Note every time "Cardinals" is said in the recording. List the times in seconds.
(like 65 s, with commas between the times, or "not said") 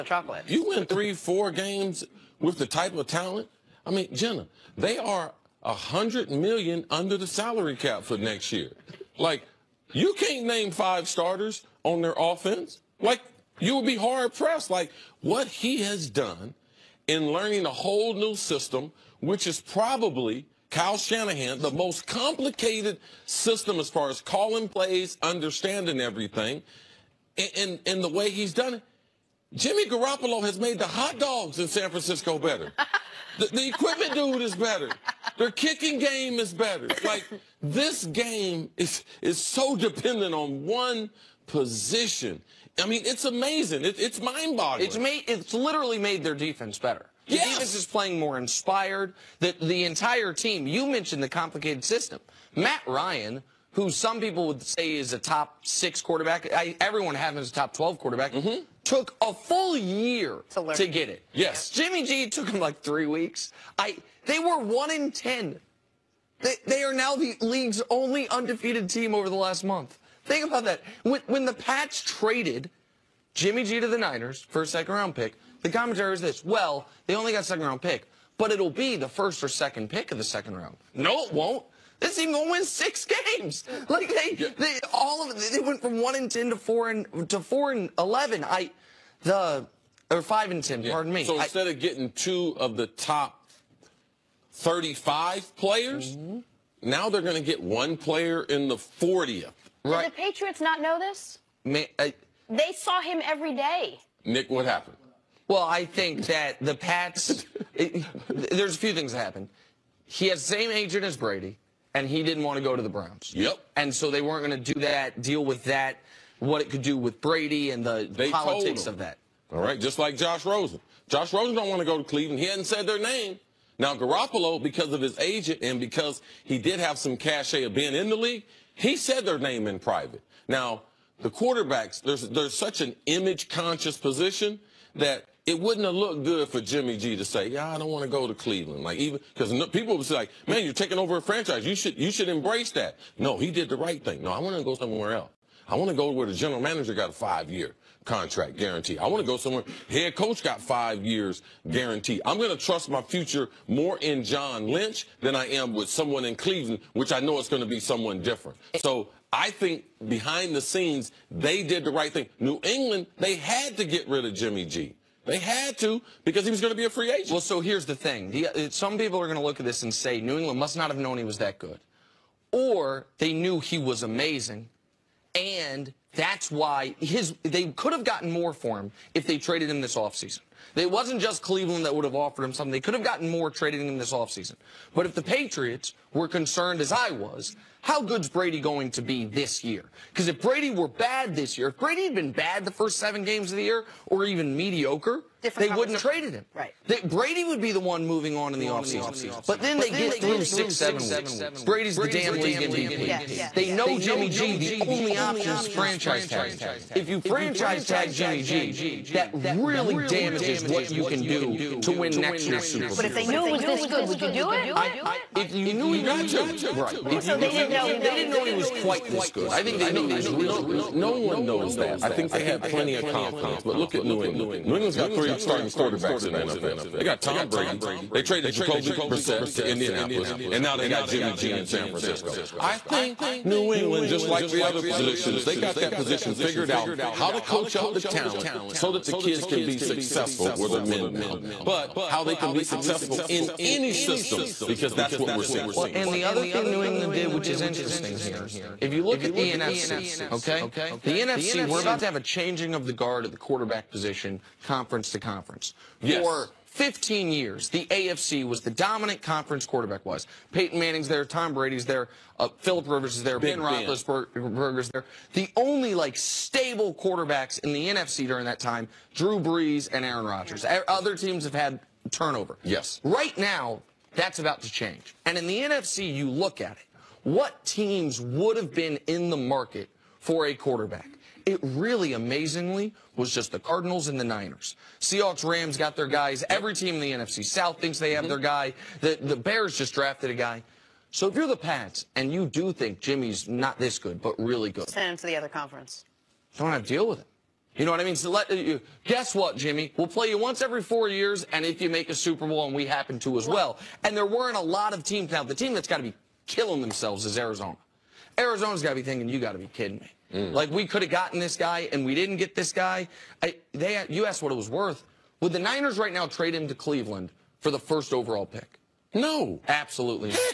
283 s.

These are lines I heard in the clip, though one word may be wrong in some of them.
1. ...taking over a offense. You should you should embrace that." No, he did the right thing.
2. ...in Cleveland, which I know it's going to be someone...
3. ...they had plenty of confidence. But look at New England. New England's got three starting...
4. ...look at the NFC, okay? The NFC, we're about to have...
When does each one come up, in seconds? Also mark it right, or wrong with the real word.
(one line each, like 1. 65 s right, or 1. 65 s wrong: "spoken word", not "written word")
1. 140 s wrong: "franchise", not "offense"
2. 156 s right
3. 222 s right
4. 249 s right.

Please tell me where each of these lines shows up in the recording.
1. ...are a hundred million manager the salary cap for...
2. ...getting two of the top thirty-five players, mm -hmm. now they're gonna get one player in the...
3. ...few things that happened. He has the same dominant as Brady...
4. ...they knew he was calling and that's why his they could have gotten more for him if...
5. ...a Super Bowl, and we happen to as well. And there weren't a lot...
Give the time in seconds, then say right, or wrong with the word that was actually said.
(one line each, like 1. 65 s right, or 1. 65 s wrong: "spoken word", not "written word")
1. 4 s wrong: "under", not "manager"
2. 91 s right
3. 108 s wrong: "agent", not "dominant"
4. 173 s wrong: "amazing", not "calling"
5. 302 s right.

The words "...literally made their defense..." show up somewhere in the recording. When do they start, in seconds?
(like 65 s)
45 s.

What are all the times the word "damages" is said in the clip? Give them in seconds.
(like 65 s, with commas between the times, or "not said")
209 s.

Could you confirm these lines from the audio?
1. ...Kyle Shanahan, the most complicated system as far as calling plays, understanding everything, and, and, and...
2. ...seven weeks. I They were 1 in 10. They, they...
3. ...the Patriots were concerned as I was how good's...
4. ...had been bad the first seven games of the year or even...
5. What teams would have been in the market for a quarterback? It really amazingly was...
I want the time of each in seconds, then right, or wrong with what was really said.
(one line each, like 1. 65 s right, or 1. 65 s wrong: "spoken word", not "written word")
1. 20 s right
2. 62 s wrong: "three", not "seven"
3. 185 s right
4. 192 s right
5. 277 s right.